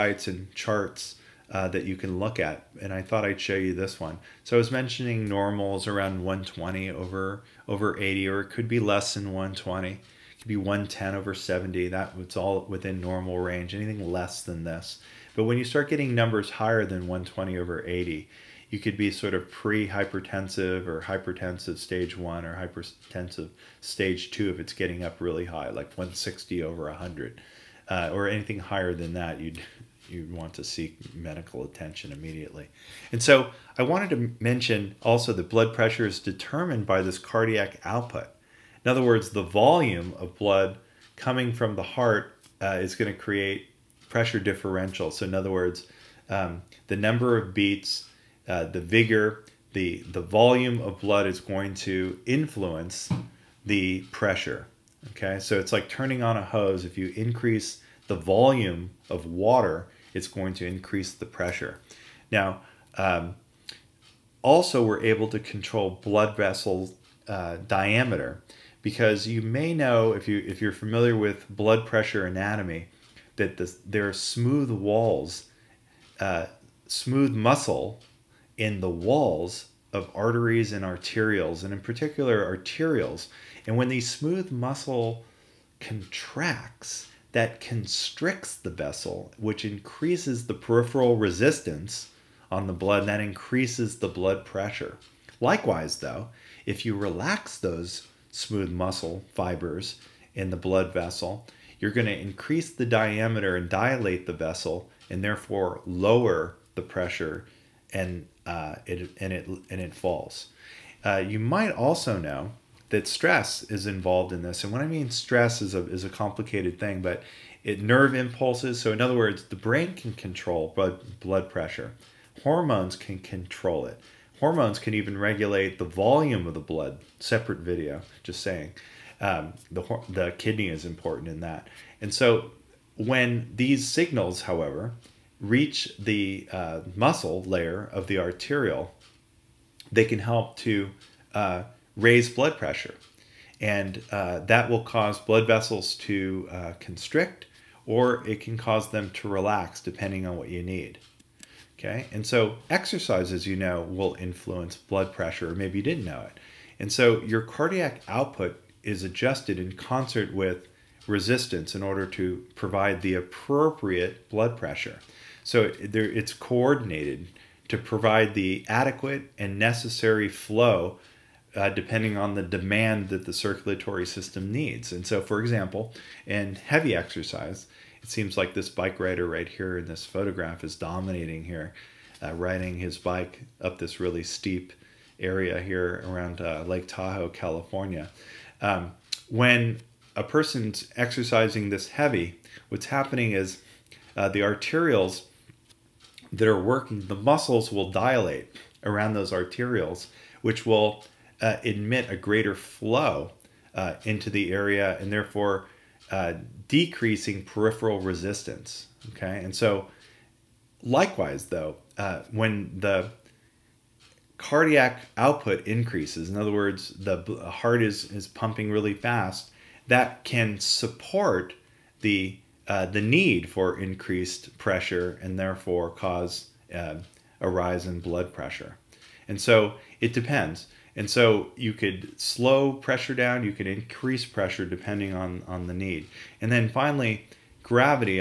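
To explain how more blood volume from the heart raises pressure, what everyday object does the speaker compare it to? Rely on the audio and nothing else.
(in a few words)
a hose.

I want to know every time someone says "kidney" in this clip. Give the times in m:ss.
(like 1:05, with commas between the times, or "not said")
2:10.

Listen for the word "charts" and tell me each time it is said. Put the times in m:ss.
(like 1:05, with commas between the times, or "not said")
0:00.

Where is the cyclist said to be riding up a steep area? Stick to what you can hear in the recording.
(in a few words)
Lake Tahoe, California.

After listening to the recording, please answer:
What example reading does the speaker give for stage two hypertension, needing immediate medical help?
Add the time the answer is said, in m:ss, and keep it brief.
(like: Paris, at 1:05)
160 over 100, at 0:25.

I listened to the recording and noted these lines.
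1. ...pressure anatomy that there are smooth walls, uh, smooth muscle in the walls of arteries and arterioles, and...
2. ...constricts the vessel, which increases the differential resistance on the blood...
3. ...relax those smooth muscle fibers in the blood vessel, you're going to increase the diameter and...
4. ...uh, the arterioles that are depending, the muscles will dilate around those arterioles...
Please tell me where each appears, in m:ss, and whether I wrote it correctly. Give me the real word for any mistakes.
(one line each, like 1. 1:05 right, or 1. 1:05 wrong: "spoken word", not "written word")
1. 1:11 right
2. 1:27 wrong: "peripheral", not "differential"
3. 1:36 right
4. 3:14 wrong: "working", not "depending".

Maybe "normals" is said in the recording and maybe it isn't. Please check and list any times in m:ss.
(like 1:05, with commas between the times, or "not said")
0:05, 0:13.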